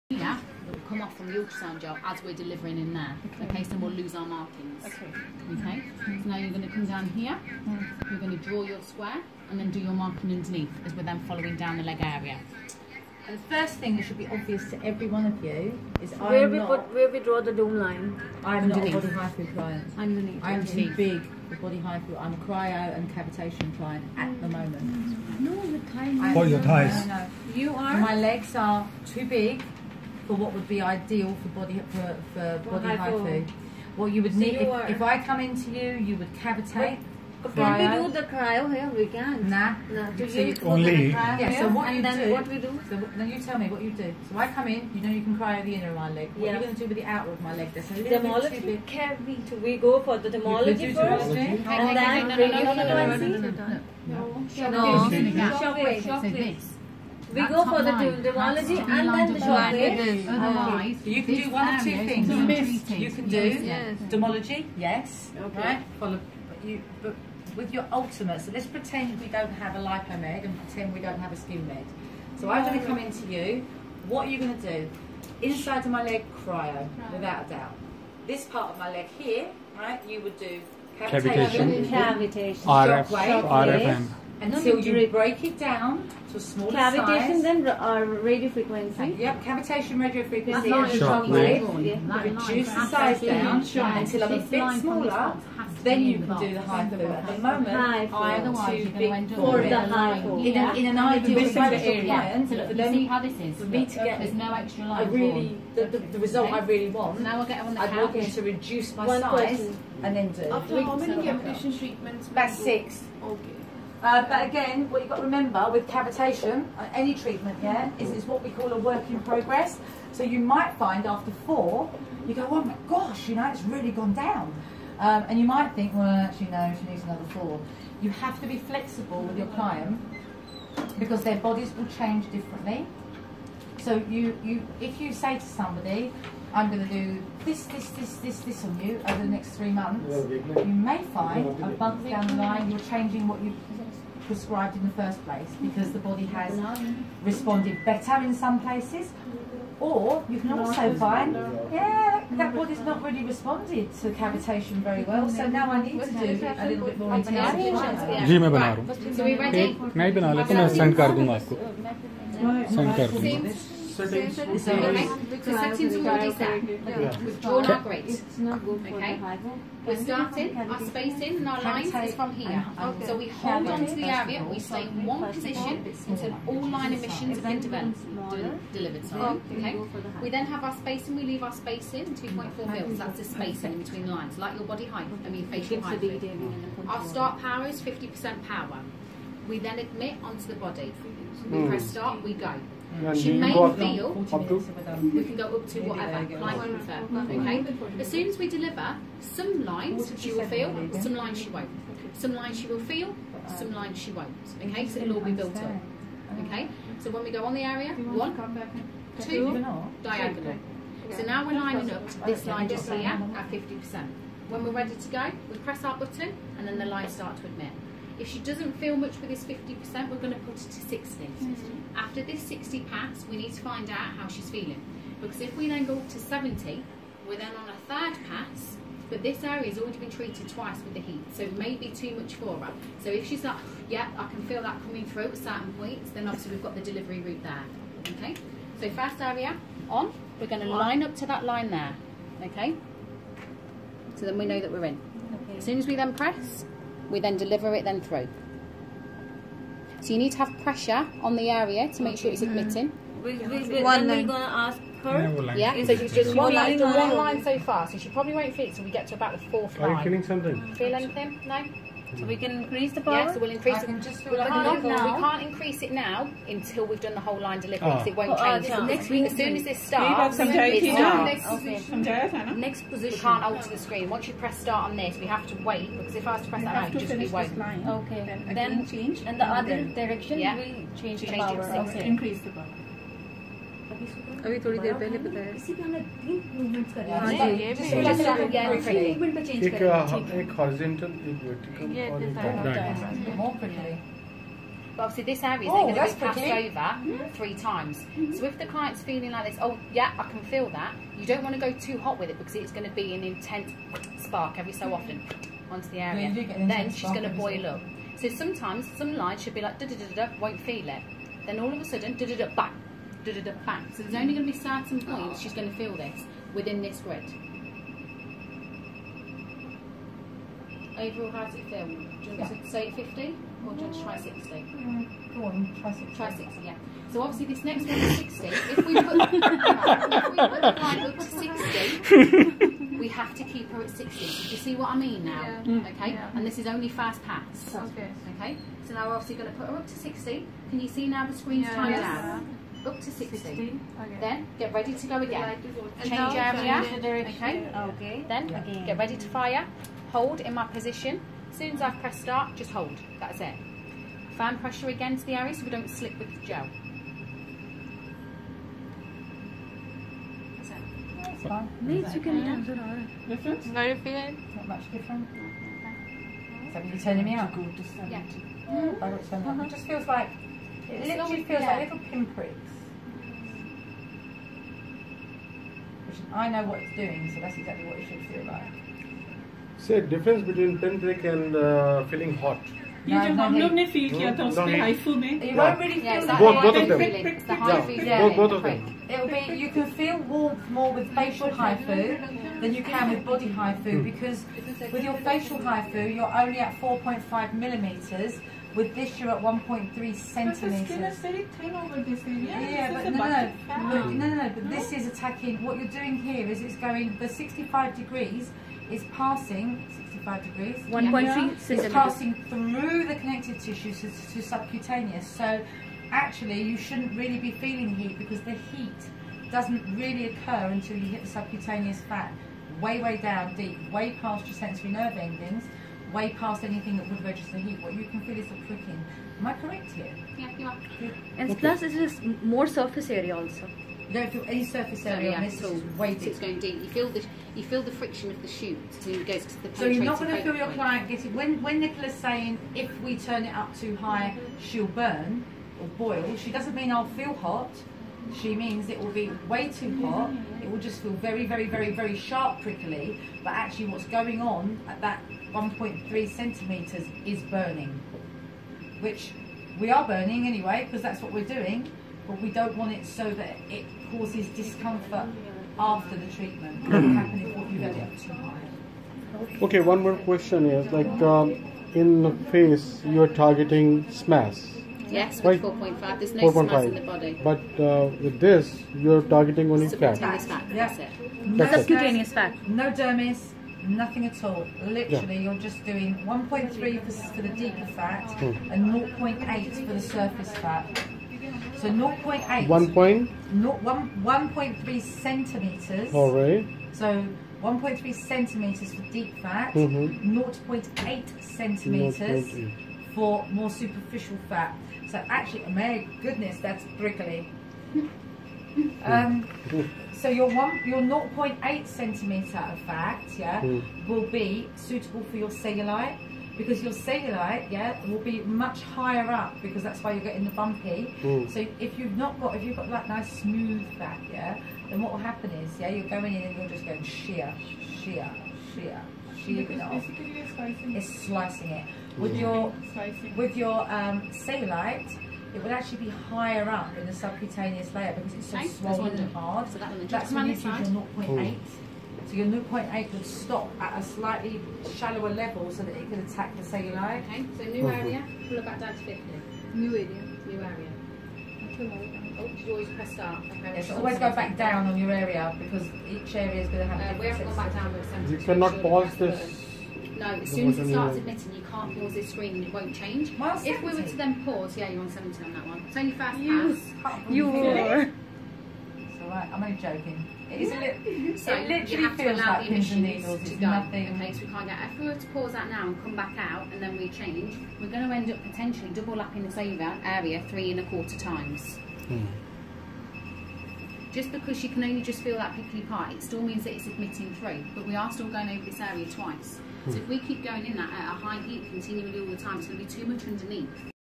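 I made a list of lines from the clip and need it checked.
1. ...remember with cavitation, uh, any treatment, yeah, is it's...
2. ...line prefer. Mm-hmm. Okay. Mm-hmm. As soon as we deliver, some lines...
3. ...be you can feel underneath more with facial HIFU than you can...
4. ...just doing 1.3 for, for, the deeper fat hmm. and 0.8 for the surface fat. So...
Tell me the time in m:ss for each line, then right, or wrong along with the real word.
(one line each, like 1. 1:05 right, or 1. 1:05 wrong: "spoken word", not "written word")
1. 1:55 right
2. 3:16 right
3. 6:29 wrong: "warmth", not "underneath"
4. 8:05 right.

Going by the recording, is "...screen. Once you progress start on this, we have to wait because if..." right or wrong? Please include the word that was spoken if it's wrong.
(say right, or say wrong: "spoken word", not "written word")
wrong: "press", not "progress".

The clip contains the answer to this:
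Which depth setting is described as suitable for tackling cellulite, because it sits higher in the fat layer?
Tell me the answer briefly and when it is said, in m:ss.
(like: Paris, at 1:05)
0.8 cm, at 8:31.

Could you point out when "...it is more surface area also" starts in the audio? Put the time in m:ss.
7:11.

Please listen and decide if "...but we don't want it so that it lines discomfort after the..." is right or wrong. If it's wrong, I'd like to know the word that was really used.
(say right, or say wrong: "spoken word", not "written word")
wrong: "causes", not "lines".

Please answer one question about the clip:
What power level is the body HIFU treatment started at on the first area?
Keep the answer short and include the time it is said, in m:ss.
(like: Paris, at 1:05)
50%, at 3:07.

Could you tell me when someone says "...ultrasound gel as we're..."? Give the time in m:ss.
0:01.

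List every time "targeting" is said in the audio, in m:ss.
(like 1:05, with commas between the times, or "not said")
7:53, 7:59.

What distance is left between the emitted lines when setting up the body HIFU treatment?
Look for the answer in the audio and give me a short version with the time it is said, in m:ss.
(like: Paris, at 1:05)
2.4 mm, at 3:02.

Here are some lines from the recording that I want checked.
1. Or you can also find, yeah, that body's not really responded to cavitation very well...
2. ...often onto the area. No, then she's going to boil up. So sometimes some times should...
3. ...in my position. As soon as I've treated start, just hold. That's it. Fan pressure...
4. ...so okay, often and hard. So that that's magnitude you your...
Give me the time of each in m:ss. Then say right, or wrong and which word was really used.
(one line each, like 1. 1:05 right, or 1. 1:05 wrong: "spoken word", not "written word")
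1. 2:29 right
2. 5:04 wrong: "lines", not "times"
3. 5:50 wrong: "pressed", not "treated"
4. 8:58 wrong: "swollen", not "often".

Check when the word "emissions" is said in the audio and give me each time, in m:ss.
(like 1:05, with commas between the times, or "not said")
2:56, 9:32.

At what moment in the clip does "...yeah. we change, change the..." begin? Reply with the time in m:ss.
4:40.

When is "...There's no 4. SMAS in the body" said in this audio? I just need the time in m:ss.
7:56.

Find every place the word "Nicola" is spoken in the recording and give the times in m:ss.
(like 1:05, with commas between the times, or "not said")
7:21.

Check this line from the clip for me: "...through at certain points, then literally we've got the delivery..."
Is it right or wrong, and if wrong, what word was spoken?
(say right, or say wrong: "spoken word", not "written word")
wrong: "obviously", not "literally".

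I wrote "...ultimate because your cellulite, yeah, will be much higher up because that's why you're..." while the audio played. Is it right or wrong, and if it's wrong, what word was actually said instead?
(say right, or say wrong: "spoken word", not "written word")
wrong: "cellulite", not "ultimate".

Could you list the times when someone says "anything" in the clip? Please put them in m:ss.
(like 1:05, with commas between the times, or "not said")
4:20, 7:06.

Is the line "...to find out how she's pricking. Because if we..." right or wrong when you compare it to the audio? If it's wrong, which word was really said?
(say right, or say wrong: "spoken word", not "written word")
wrong: "feeling", not "pricking".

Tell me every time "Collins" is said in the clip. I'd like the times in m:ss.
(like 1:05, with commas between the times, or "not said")
not said.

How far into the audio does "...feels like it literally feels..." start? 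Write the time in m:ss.
6:09.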